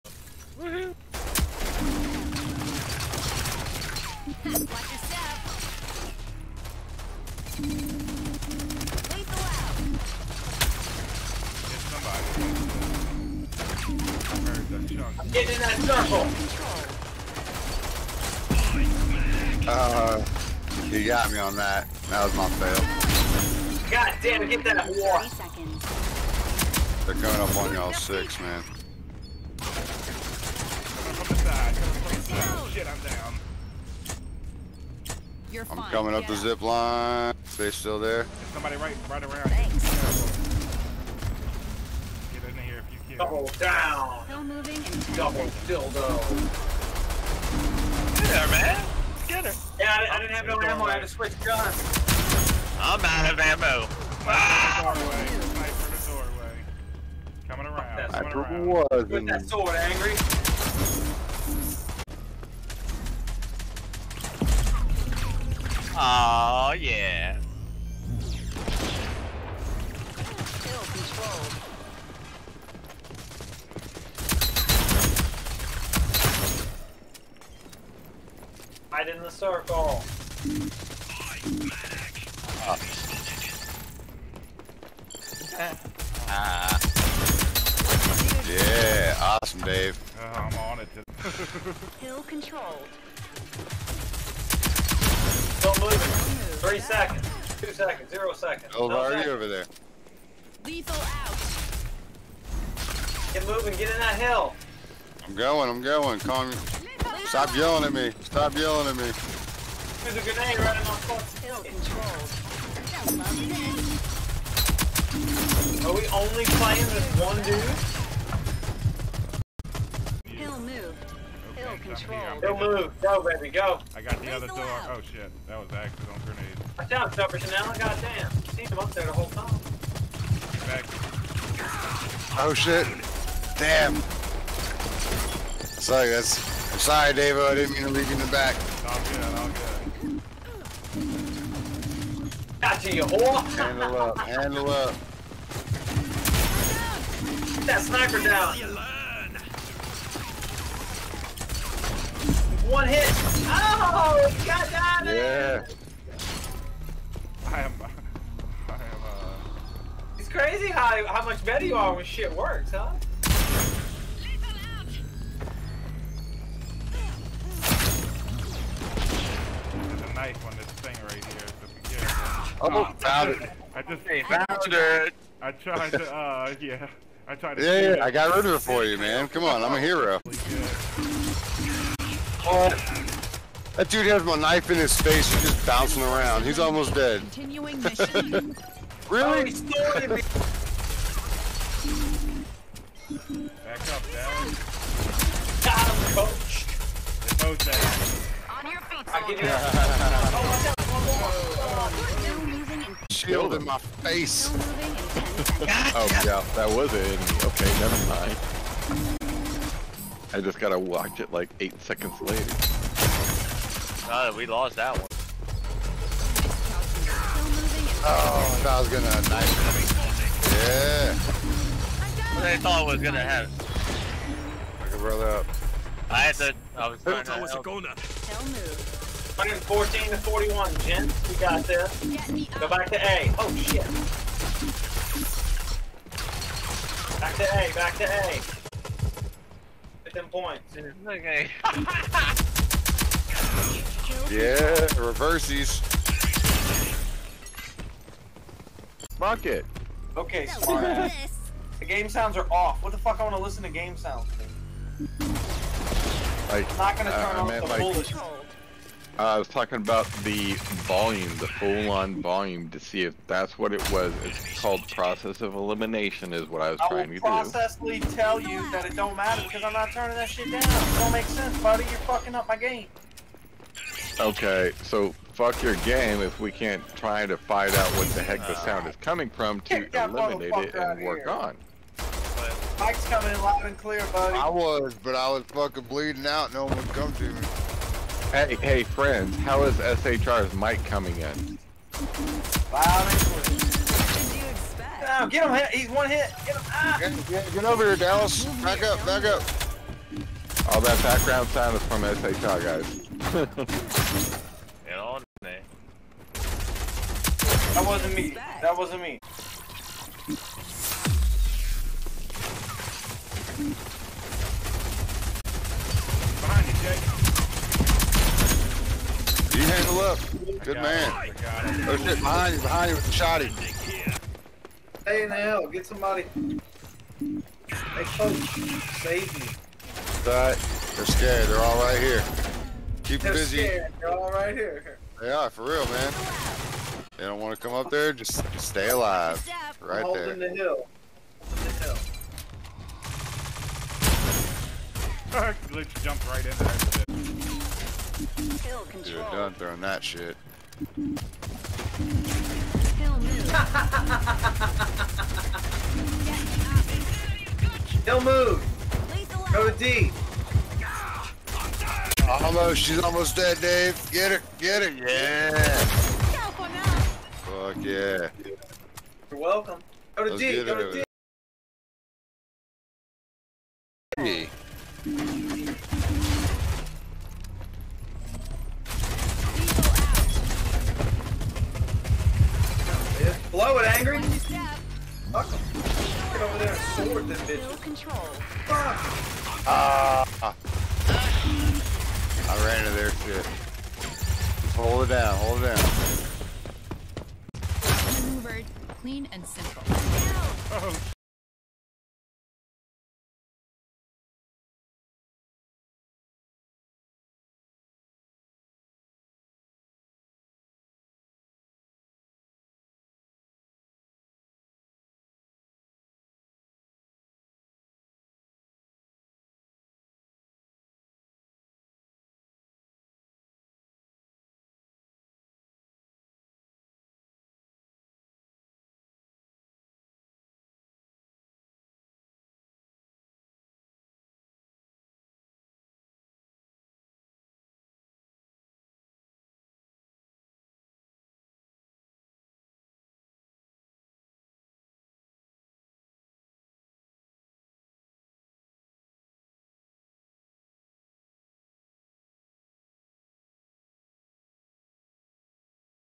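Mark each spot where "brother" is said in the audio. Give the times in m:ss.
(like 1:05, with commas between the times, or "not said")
3:44.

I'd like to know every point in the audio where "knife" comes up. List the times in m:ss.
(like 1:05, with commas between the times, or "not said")
2:50, 3:04, 3:39.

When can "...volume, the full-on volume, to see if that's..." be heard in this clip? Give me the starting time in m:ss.
4:20.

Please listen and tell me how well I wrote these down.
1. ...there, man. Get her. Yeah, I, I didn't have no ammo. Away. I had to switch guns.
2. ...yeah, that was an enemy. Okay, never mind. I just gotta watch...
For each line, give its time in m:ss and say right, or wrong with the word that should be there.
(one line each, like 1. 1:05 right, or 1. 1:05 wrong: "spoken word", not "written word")
1. 0:48 right
2. 3:26 right.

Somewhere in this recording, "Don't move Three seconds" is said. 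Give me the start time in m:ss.
1:35.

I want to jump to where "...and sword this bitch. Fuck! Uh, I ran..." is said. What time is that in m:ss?
6:26.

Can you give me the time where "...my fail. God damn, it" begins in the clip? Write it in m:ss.
0:22.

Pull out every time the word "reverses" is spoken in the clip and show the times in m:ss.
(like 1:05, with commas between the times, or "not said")
4:05.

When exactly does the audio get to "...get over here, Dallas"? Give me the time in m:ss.
4:57.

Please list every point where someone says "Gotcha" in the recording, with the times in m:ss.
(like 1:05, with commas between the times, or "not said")
2:22.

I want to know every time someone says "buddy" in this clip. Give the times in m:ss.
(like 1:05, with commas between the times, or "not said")
4:31, 4:44.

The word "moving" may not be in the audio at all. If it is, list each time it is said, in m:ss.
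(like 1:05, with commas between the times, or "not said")
0:44, 1:43.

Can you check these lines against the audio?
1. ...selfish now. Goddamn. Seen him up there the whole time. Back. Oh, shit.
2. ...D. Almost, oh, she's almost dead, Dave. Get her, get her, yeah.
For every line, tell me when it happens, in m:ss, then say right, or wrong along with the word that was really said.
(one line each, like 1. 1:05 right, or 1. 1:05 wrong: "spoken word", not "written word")
1. 2:07 right
2. 5:59 right.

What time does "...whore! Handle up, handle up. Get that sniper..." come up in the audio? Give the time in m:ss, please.
2:23.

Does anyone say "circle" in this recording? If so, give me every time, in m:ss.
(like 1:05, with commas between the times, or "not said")
0:15, 1:19.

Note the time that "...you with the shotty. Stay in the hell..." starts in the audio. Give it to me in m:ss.
5:22.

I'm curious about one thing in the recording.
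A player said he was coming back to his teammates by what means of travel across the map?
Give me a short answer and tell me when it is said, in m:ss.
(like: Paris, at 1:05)
zip line, at 0:36.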